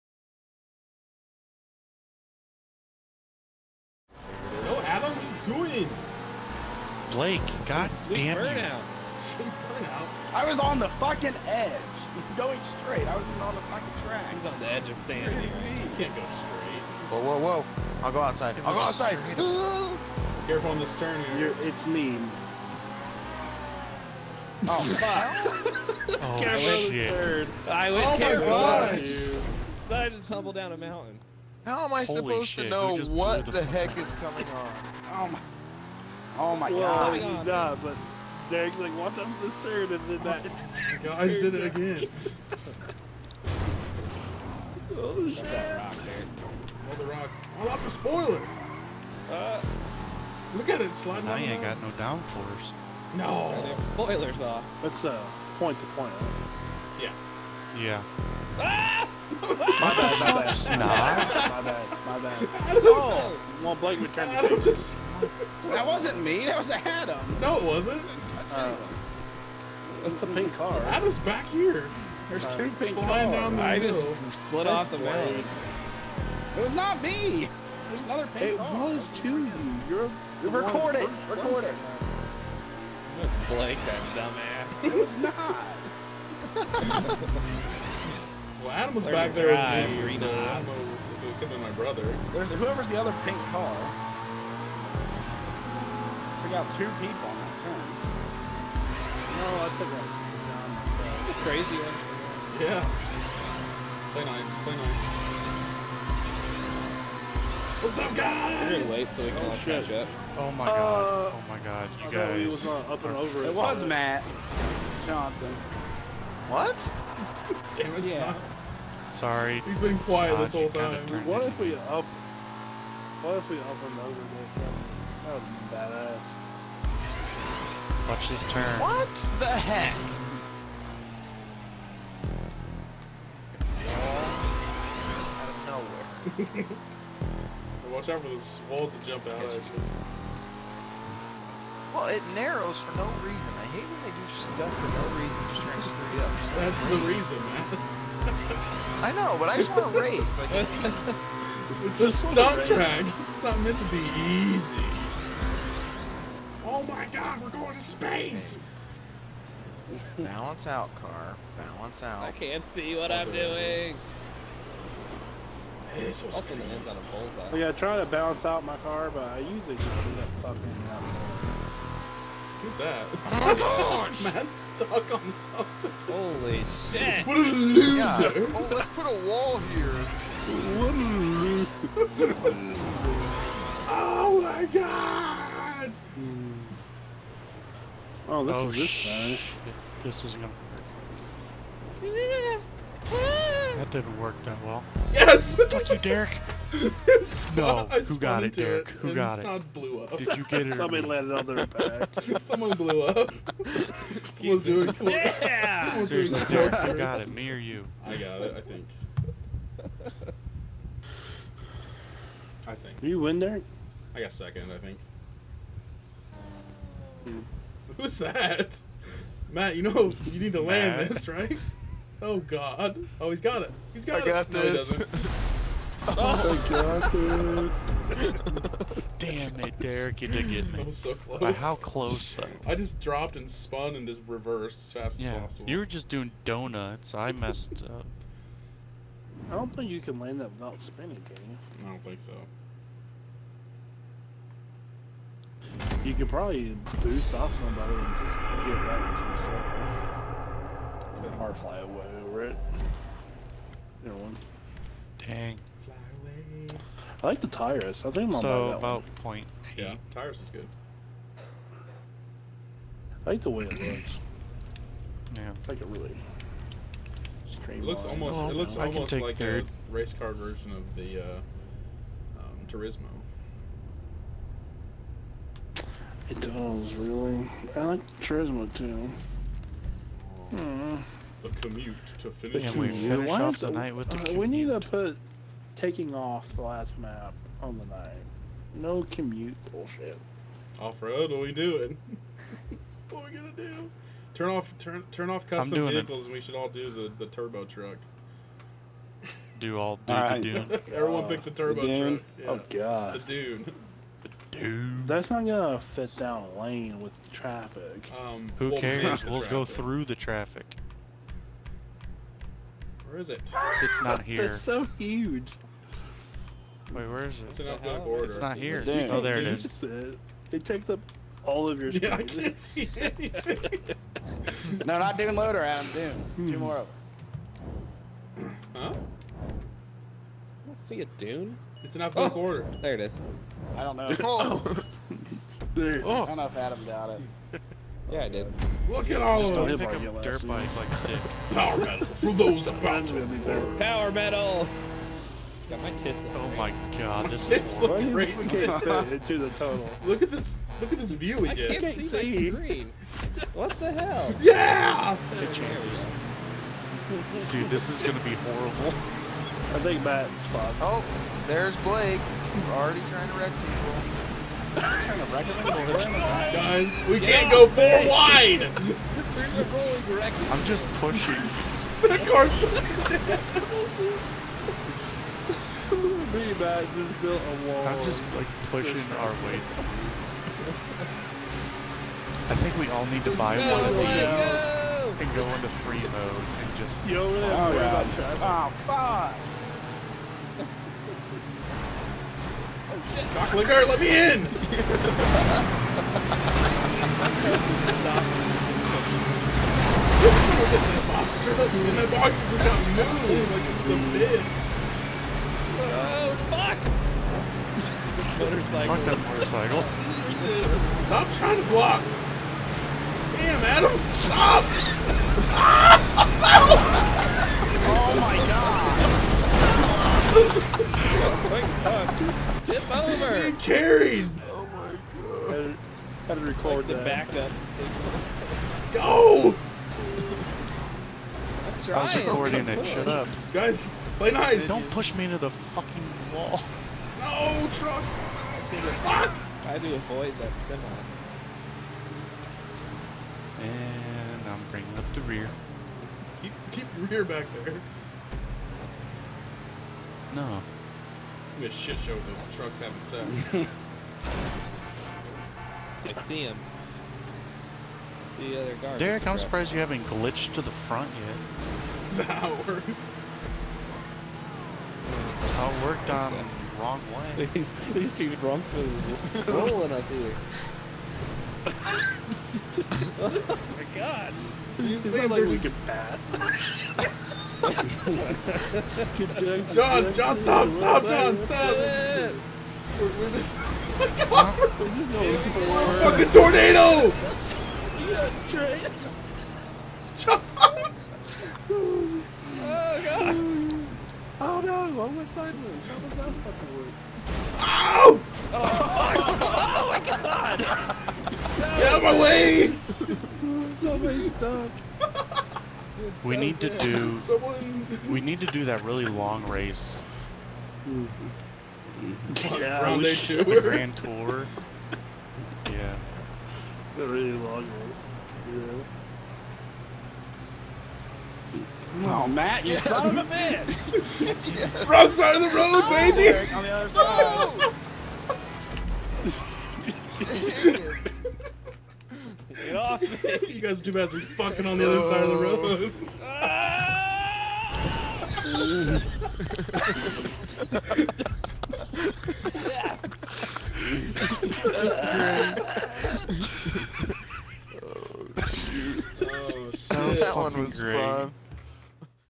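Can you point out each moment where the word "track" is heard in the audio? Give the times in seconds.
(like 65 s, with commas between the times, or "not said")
14 s, 152 s.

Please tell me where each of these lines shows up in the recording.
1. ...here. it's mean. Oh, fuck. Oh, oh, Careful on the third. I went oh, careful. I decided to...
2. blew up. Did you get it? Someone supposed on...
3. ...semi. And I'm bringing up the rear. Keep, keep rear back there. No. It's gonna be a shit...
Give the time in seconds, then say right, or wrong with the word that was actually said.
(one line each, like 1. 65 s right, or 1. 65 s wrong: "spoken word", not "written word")
1. 21 s right
2. 199 s wrong: "landed", not "supposed"
3. 440 s right.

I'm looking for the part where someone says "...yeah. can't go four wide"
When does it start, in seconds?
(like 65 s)
367 s.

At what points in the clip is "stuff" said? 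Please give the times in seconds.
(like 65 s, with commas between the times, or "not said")
144 s, 251 s.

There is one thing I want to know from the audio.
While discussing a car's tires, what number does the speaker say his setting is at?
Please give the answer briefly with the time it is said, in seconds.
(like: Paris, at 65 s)
1.8, at 259 s.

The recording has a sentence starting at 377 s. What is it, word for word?
I'm just like pushing our way I think we all need to buy no, one of these no.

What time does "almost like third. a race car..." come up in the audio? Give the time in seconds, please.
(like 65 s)
268 s.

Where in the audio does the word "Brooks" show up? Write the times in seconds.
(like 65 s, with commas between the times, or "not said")
not said.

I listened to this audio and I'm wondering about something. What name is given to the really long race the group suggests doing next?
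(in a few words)
Grand Tour.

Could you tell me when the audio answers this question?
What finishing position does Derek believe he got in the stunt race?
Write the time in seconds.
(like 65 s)
214 s.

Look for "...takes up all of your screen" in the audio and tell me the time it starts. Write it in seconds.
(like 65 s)
320 s.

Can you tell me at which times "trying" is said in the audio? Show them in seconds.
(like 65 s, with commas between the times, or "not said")
145 s, 363 s, 411 s.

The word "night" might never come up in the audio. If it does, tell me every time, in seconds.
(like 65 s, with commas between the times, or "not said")
283 s, 287 s.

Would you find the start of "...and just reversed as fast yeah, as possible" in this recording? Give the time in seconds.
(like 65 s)
233 s.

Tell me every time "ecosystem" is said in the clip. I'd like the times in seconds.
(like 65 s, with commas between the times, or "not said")
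not said.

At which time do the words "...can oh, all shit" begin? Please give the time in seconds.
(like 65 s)
109 s.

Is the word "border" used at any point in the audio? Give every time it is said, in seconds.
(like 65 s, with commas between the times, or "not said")
318 s, 332 s.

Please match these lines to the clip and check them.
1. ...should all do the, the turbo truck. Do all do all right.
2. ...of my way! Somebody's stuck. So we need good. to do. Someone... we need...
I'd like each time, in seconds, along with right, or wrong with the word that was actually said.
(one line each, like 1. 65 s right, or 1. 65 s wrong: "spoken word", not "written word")
1. 296 s right
2. 501 s right.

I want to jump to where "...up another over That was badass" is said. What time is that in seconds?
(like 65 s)
123 s.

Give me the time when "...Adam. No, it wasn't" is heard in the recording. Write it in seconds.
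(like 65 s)
66 s.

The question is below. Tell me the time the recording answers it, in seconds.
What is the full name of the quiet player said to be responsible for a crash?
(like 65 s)
113 s.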